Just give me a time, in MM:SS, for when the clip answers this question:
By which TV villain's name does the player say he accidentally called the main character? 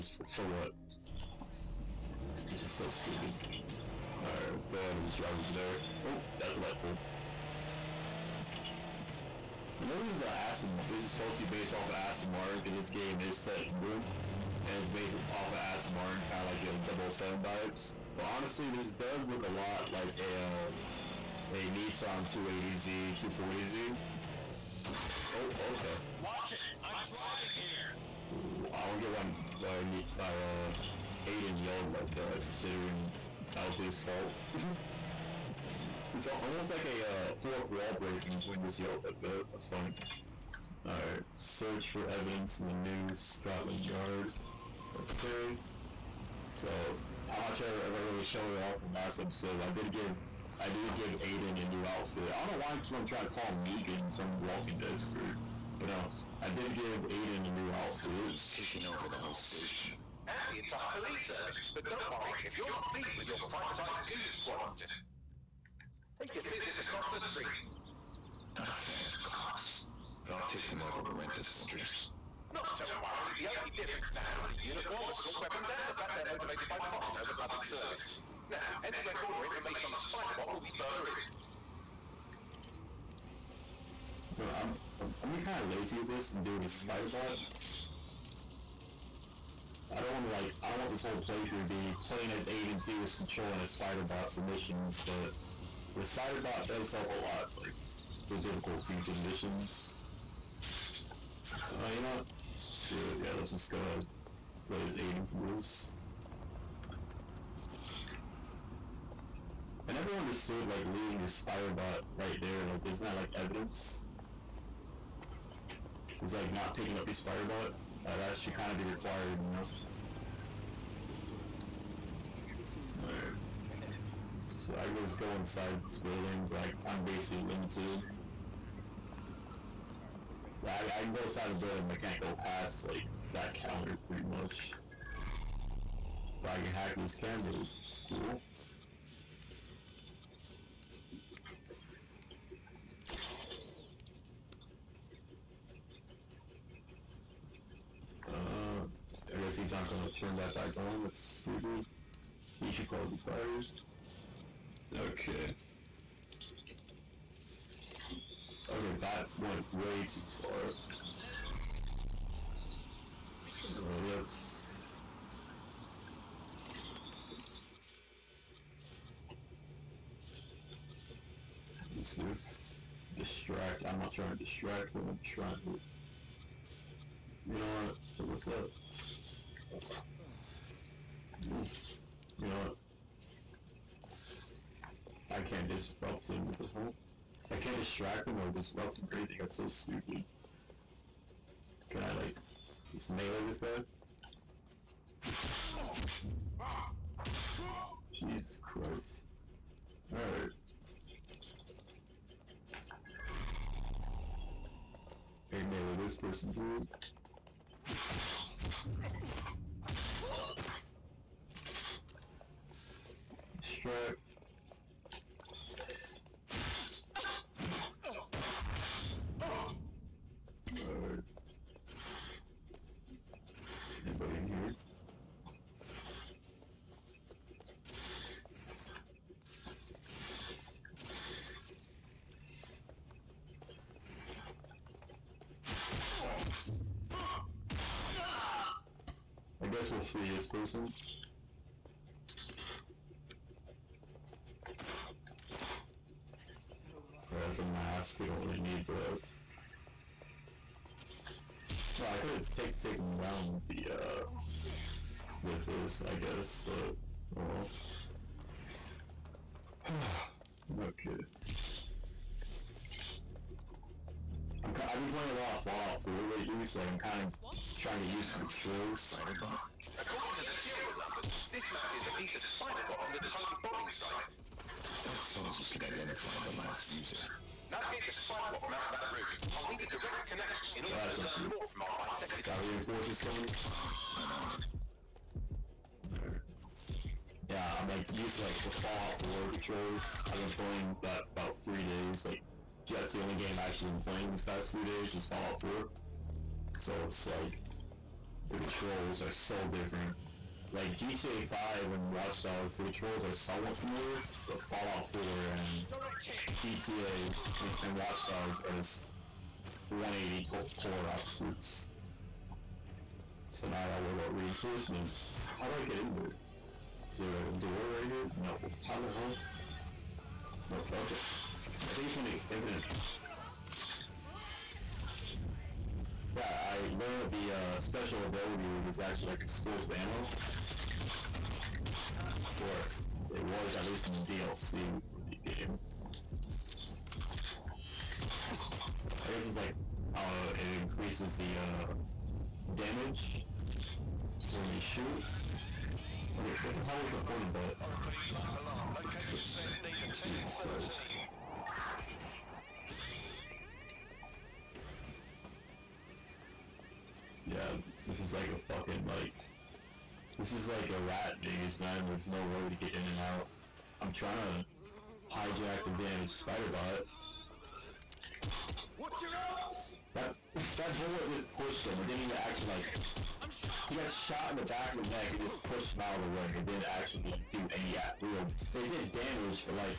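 00:53.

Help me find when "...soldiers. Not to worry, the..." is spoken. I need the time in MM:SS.
01:11.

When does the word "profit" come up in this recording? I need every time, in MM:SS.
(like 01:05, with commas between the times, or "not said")
01:16.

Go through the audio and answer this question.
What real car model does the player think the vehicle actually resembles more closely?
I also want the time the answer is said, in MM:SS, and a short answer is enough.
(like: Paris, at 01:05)
Nissan 280Z, at 00:21.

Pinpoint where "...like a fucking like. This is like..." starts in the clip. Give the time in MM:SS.
05:58.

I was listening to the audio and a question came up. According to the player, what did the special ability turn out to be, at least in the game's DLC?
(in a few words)
explosive ammo.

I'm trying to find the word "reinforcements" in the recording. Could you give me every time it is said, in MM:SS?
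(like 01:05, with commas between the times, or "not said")
04:42, 05:14.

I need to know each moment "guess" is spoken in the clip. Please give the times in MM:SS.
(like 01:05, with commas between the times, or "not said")
02:29, 03:59, 04:16, 05:39.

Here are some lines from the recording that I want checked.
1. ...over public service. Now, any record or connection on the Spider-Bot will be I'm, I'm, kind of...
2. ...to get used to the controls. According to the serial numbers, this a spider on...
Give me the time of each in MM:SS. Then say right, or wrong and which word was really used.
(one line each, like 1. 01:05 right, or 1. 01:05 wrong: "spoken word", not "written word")
1. 01:17 wrong: "information", not "connection"
2. 04:28 right.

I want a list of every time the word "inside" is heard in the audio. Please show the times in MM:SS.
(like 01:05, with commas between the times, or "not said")
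02:05, 02:11.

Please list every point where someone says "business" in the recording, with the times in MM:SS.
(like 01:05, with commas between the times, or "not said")
01:06.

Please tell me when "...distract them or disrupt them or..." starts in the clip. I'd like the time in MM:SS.
03:07.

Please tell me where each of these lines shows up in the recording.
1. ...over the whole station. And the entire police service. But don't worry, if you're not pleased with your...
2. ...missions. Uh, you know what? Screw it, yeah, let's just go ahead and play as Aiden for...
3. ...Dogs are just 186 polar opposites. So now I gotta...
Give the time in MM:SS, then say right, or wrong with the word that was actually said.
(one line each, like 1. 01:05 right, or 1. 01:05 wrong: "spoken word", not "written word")
1. 00:58 right
2. 01:39 right
3. 05:08 wrong: "180", not "186".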